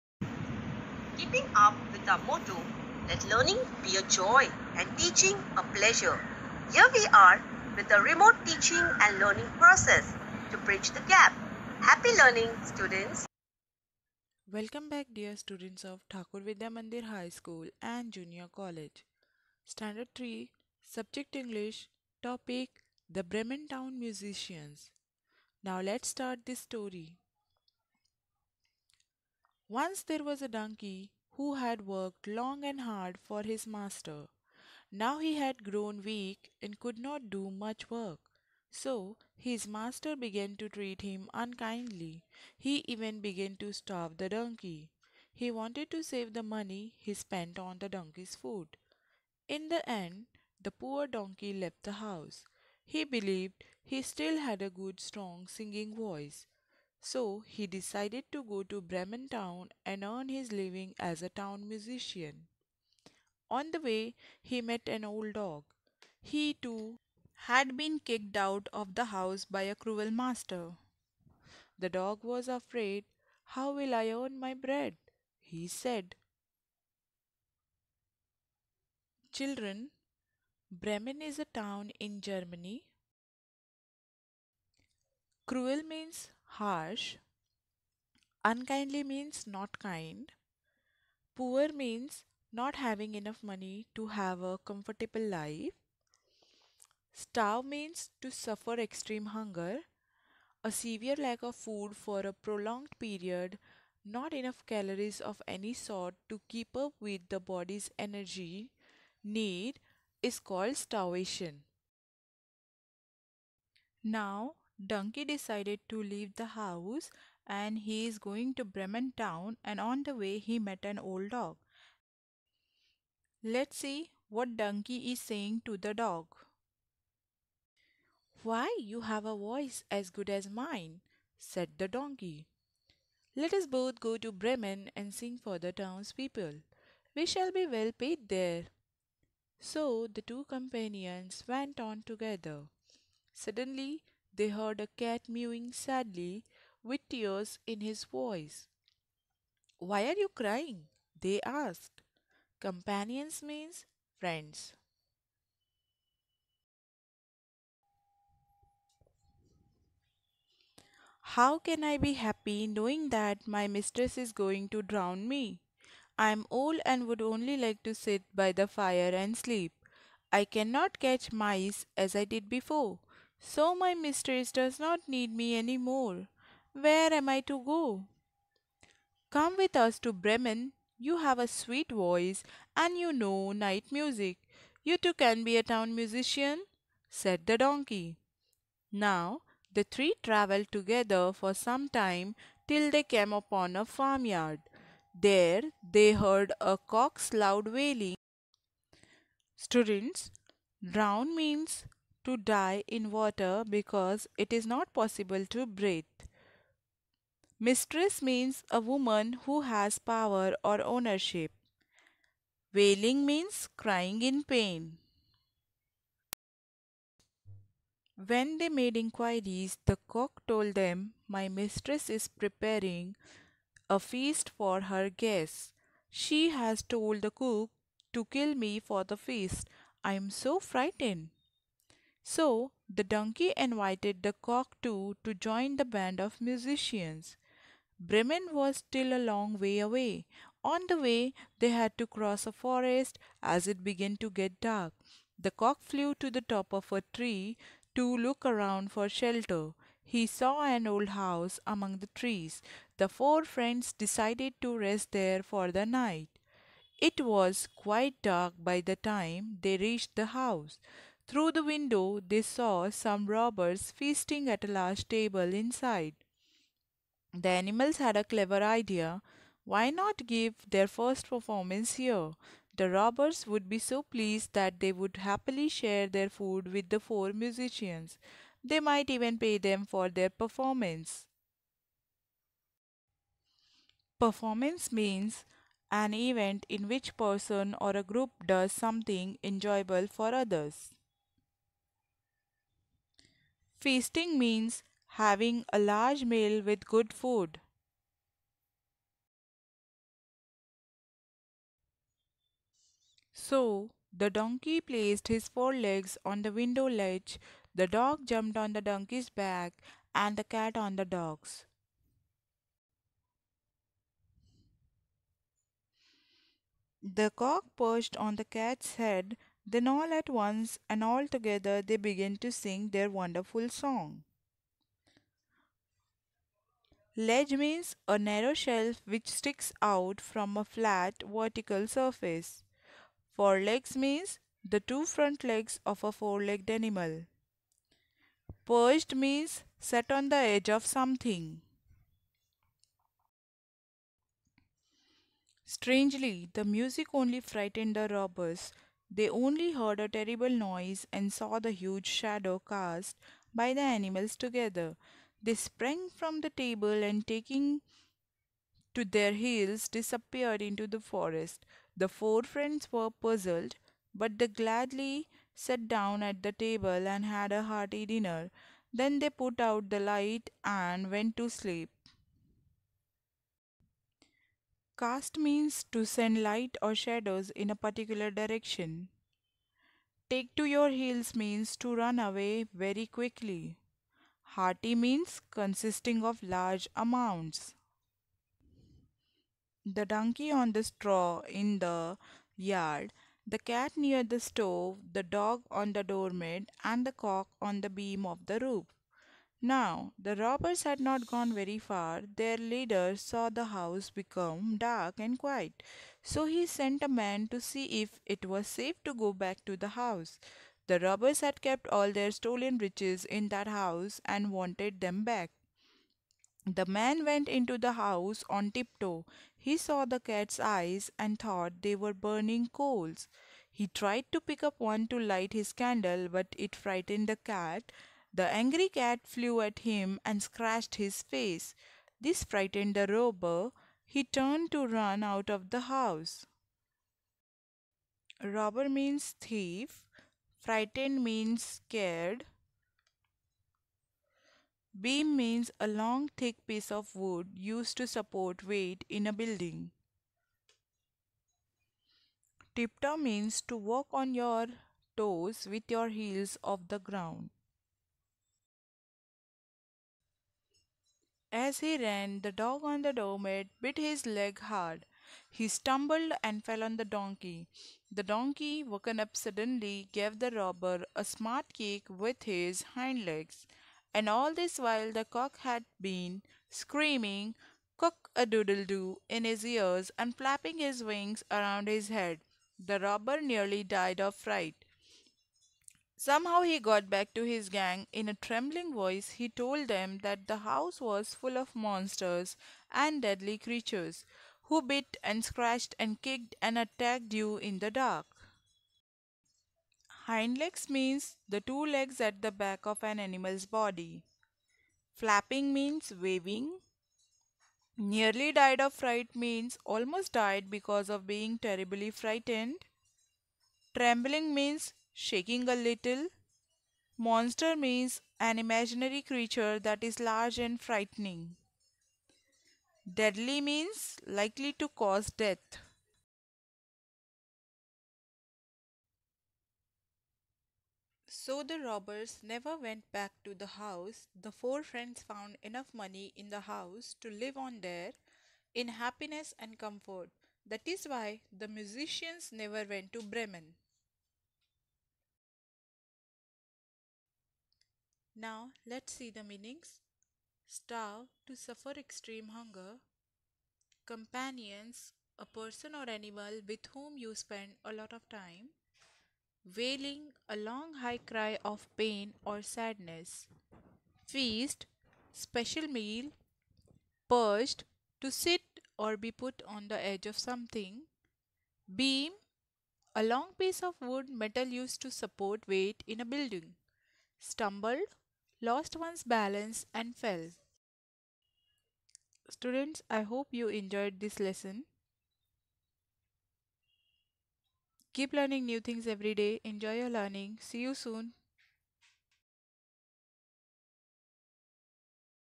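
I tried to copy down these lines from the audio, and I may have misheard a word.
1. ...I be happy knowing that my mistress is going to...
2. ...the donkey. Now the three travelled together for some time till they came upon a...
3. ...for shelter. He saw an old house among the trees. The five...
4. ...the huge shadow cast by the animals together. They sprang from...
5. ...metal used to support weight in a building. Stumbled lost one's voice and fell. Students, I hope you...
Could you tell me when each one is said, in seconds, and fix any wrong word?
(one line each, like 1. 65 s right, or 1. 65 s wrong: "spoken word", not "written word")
1. 161 s right
2. 187 s right
3. 248 s wrong: "four", not "five"
4. 351 s right
5. 574 s wrong: "balance", not "voice".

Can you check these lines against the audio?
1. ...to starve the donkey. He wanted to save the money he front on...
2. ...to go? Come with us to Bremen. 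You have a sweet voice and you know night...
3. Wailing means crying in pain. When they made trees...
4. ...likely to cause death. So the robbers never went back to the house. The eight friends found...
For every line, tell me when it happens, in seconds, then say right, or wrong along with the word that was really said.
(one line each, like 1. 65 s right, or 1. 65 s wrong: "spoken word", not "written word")
1. 43 s wrong: "spent", not "front"
2. 177 s right
3. 212 s wrong: "inquiries", not "trees"
4. 524 s wrong: "four", not "eight".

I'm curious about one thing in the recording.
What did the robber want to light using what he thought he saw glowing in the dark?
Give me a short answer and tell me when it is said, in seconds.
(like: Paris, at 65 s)
His candle, at 425 s.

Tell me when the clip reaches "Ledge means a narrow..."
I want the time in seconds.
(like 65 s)
327 s.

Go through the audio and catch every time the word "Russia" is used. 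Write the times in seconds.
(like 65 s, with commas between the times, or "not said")
not said.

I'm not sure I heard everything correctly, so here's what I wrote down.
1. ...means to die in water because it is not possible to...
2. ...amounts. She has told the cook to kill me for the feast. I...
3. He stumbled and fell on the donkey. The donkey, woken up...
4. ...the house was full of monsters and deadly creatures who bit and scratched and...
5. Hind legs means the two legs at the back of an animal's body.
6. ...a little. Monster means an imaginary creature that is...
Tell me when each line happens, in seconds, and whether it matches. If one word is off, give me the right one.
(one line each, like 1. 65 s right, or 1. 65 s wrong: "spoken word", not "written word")
1. 201 s right
2. 225 s wrong: "guests", not "amounts"
3. 465 s right
4. 490 s right
5. 500 s right
6. 515 s right.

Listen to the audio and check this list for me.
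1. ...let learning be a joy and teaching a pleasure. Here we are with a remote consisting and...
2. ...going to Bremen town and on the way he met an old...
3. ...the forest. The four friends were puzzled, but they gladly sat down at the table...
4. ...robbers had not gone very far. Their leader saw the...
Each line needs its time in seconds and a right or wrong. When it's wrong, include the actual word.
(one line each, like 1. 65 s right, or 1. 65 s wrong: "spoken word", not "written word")
1. 3 s wrong: "teaching", not "consisting"
2. 118 s right
3. 360 s right
4. 400 s right.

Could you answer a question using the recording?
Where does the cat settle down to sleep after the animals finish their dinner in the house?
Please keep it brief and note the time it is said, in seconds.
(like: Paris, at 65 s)
Near the stove, at 393 s.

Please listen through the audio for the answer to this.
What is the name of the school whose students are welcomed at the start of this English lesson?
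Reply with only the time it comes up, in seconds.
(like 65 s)
16 s.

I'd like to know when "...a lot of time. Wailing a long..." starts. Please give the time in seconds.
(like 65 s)
557 s.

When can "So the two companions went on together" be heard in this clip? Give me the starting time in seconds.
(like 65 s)
139 s.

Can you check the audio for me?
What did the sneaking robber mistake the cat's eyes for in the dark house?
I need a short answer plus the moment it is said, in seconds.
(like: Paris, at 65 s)
Burning coals, at 422 s.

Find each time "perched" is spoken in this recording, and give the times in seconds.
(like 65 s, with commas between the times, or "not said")
317 s, 338 s, 567 s.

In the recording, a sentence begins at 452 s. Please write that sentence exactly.
Tiptoe means to walk on your toes with your heels off the ground.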